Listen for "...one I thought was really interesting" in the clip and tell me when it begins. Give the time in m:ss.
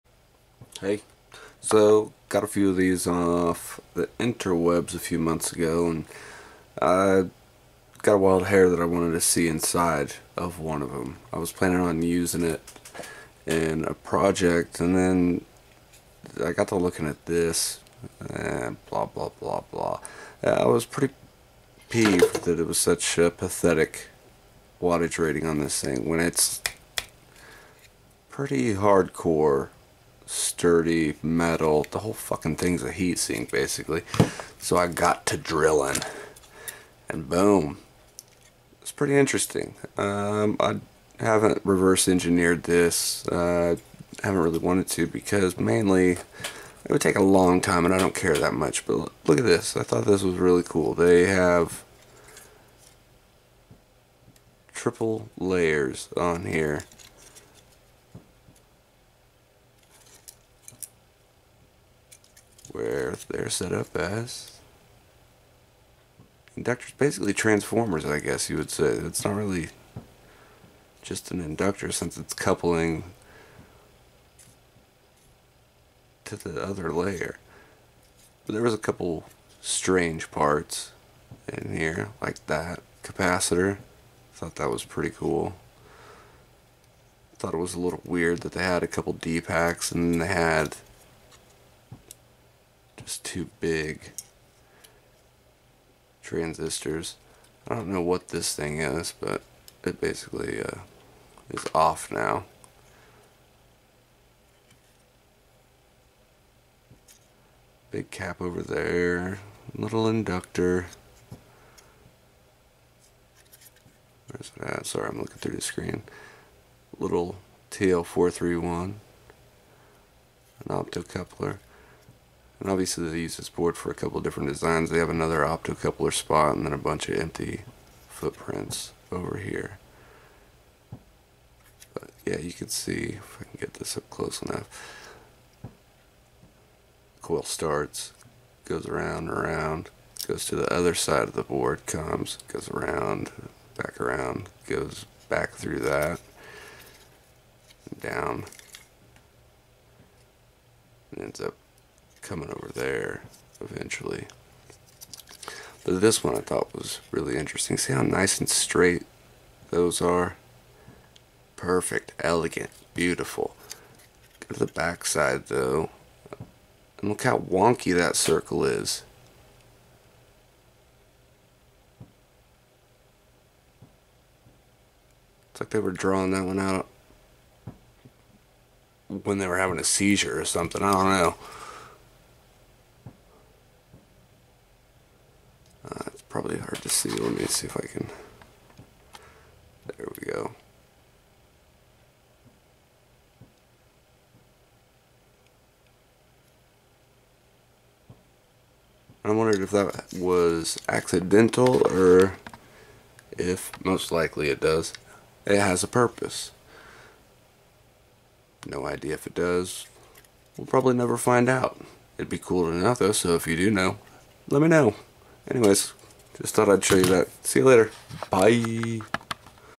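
2:36.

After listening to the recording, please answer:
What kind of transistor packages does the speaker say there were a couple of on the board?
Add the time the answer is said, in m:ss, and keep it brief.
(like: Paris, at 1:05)
DPAKs, at 1:29.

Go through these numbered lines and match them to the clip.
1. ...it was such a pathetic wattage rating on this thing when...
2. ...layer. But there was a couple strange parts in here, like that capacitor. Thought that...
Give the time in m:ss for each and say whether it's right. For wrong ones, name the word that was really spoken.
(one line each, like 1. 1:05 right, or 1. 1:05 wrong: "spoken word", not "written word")
1. 0:22 right
2. 1:16 right.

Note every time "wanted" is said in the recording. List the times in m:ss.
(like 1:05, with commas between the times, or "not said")
0:08, 0:44.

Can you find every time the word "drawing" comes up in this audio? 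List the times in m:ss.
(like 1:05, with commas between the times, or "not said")
2:55.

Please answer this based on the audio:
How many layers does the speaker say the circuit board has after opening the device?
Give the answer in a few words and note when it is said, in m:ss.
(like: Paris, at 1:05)
triple, at 0:54.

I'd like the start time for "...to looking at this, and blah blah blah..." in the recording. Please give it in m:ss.
0:16.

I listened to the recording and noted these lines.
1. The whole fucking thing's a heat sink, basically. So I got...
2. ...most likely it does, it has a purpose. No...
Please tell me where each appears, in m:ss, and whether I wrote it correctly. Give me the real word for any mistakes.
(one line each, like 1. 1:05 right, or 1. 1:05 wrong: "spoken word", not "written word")
1. 0:31 right
2. 3:23 right.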